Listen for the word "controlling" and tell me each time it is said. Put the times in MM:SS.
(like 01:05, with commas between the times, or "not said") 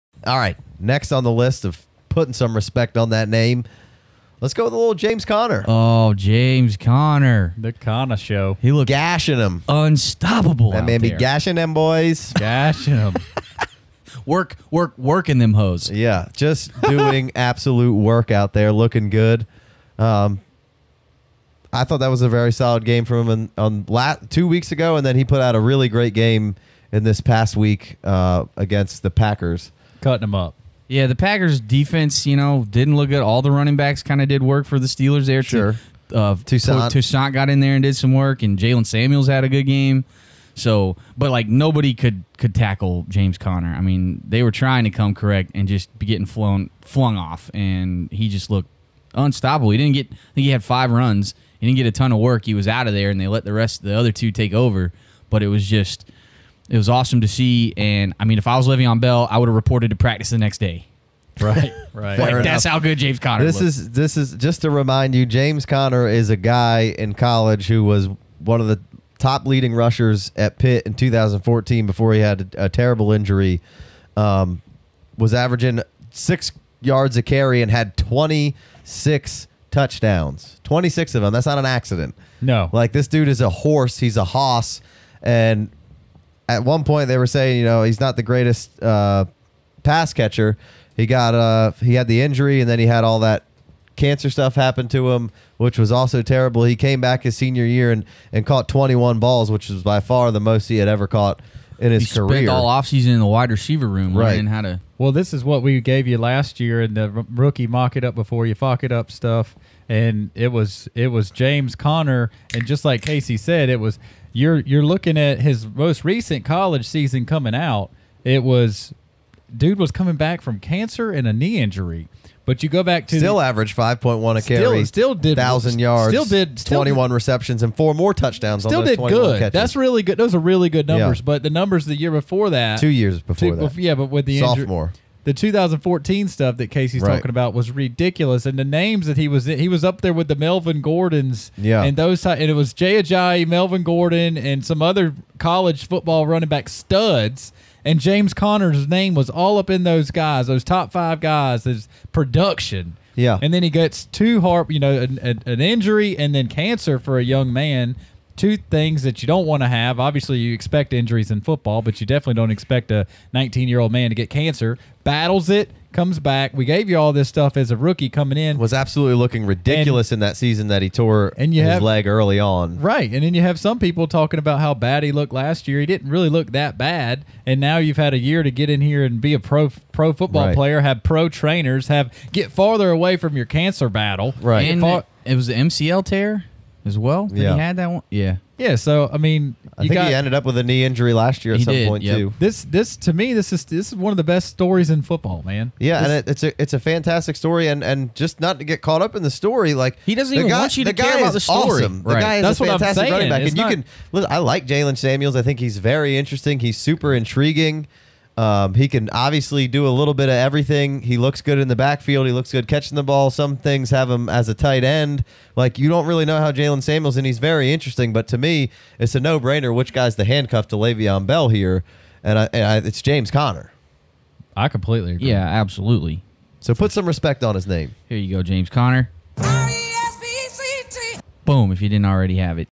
not said.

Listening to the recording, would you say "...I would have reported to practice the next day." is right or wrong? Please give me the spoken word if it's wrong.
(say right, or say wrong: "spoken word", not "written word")
right.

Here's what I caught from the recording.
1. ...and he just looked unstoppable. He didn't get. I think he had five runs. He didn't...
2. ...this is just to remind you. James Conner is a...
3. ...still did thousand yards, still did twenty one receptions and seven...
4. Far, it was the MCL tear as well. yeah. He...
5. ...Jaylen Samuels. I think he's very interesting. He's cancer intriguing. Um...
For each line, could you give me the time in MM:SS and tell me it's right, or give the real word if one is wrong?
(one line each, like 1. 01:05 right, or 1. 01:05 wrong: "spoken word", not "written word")
1. 00:47 right
2. 01:03 right
3. 02:04 wrong: "four", not "seven"
4. 03:04 right
5. 03:24 wrong: "super", not "cancer".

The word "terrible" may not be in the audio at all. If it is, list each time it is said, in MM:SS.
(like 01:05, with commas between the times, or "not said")
01:12, 01:36.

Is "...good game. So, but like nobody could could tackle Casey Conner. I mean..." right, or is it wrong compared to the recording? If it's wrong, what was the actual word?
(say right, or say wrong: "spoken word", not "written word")
wrong: "James", not "Casey".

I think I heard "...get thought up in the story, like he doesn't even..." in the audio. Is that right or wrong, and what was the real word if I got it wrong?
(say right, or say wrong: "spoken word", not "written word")
wrong: "caught", not "thought".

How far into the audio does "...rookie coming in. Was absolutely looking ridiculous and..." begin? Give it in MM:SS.
02:47.